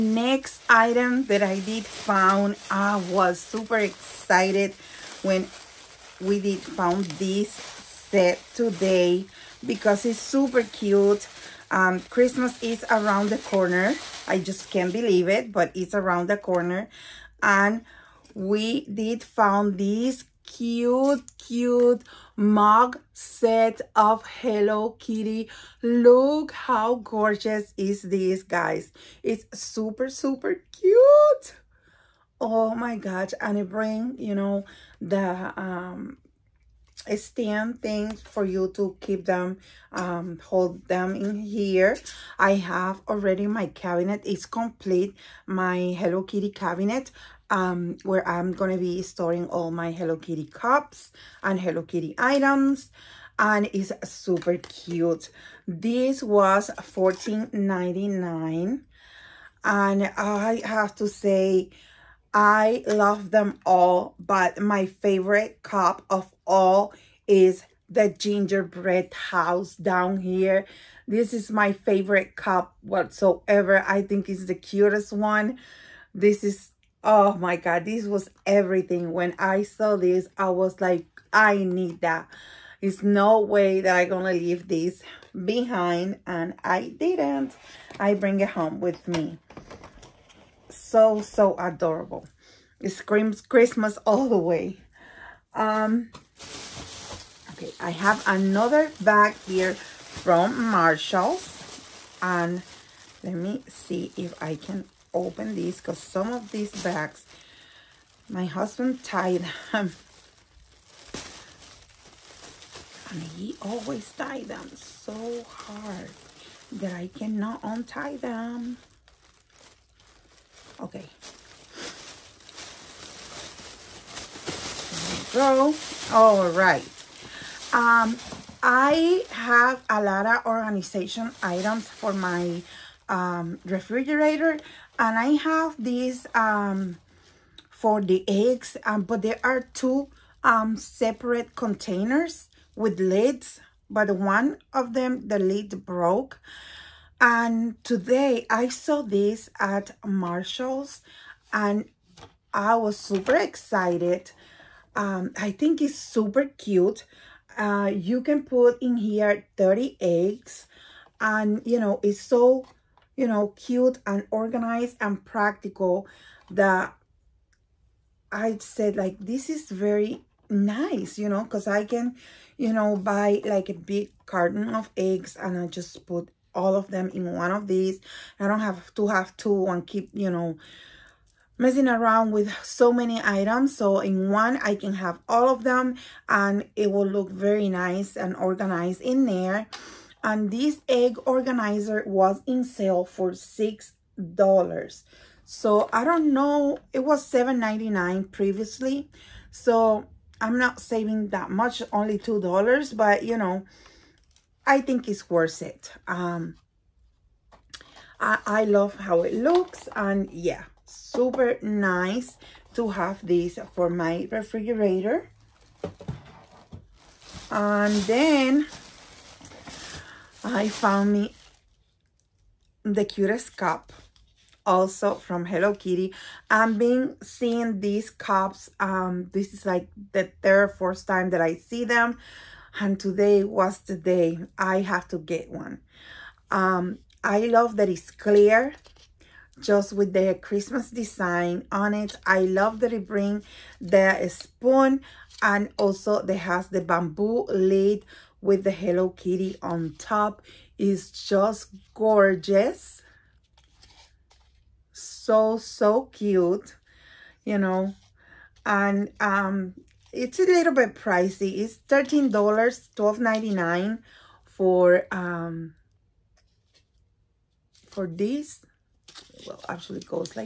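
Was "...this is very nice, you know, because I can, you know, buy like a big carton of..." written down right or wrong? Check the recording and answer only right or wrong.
right.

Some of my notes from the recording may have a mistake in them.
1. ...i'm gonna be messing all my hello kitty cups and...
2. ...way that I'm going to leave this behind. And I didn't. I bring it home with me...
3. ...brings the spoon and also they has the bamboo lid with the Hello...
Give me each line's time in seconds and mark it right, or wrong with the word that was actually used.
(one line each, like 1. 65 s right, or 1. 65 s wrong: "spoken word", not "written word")
1. 48 s wrong: "storing", not "messing"
2. 83 s right
3. 243 s right.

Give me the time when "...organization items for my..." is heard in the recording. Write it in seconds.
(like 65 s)
130 s.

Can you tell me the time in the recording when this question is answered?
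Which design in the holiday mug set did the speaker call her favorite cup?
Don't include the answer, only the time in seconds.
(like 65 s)
68 s.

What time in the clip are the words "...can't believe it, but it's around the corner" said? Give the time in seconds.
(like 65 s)
14 s.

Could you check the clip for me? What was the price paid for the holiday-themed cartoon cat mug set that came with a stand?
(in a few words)
$14.99.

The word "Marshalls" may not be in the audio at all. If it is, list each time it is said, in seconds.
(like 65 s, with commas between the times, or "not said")
100 s, 150 s.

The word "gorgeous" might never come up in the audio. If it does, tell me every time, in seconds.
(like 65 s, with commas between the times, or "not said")
27 s, 251 s.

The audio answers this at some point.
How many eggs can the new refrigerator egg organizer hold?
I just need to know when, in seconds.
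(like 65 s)
159 s.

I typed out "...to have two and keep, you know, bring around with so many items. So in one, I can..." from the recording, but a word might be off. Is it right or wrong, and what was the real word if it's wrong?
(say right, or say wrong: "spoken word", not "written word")
wrong: "messing", not "bring".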